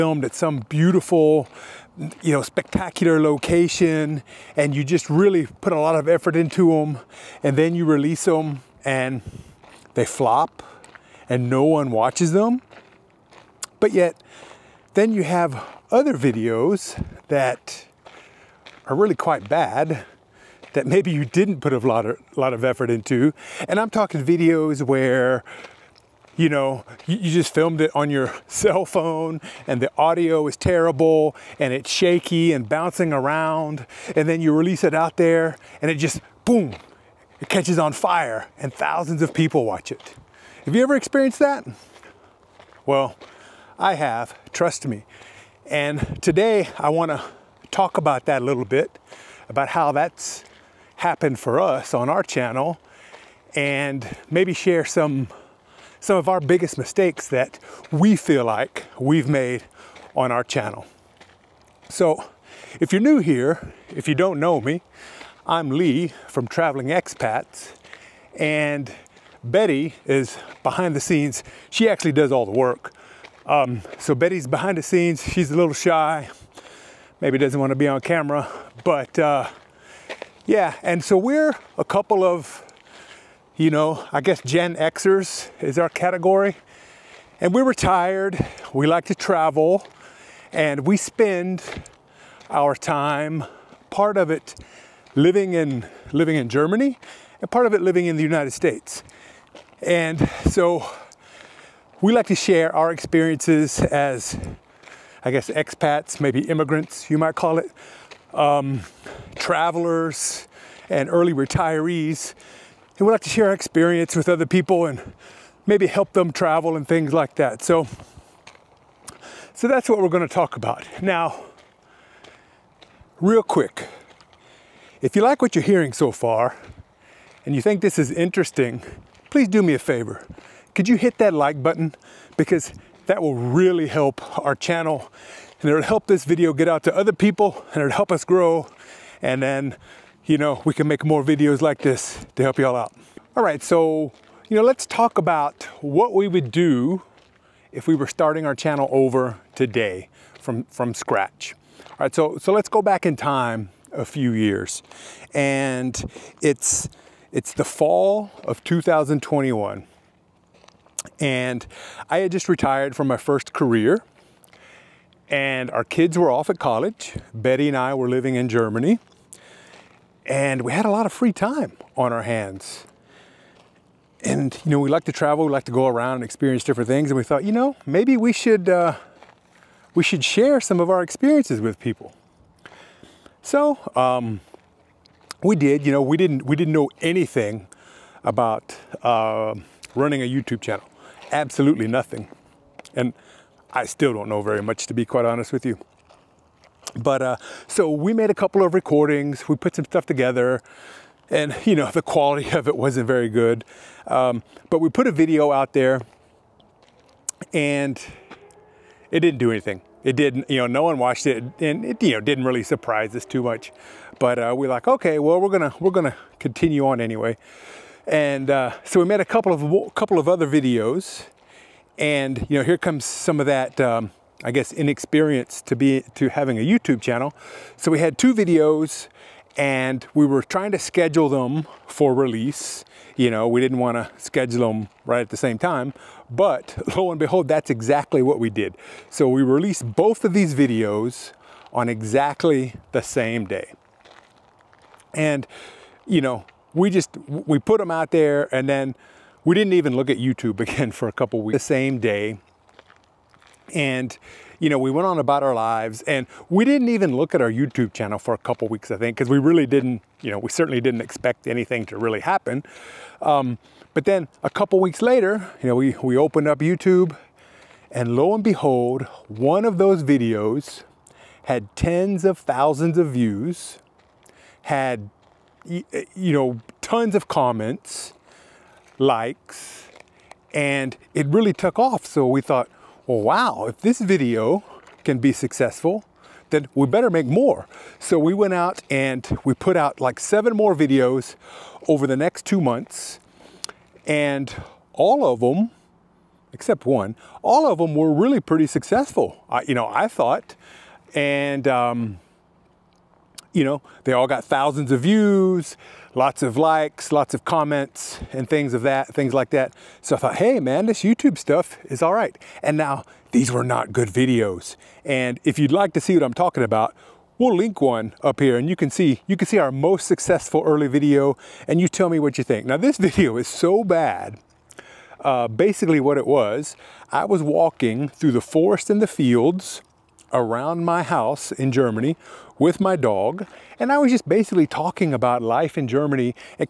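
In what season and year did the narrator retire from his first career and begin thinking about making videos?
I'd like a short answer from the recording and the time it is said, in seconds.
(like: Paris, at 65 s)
fall of 2021, at 157 s.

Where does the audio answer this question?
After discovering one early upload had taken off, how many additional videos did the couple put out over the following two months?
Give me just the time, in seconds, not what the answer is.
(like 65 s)
290 s.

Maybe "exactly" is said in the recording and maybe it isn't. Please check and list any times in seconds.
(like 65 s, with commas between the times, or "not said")
237 s, 241 s.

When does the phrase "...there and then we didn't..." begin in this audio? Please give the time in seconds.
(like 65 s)
248 s.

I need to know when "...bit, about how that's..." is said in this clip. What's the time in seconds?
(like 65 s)
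48 s.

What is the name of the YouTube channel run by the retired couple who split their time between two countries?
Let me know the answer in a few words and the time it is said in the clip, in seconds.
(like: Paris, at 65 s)
Traveling Expats, at 66 s.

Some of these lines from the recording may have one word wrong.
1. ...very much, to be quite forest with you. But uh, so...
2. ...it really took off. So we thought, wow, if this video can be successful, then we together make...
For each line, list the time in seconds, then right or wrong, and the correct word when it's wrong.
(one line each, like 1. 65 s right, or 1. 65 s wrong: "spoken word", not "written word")
1. 194 s wrong: "honest", not "forest"
2. 281 s wrong: "better", not "together".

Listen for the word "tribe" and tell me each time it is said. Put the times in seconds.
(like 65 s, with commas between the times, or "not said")
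not said.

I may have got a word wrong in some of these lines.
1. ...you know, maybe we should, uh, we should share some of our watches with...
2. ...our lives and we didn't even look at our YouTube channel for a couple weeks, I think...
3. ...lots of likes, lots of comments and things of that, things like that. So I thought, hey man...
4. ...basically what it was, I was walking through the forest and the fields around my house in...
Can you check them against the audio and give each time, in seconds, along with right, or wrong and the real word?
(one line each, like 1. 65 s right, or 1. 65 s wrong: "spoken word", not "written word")
1. 177 s wrong: "experiences", not "watches"
2. 255 s right
3. 306 s right
4. 325 s right.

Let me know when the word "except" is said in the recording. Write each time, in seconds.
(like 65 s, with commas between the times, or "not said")
296 s.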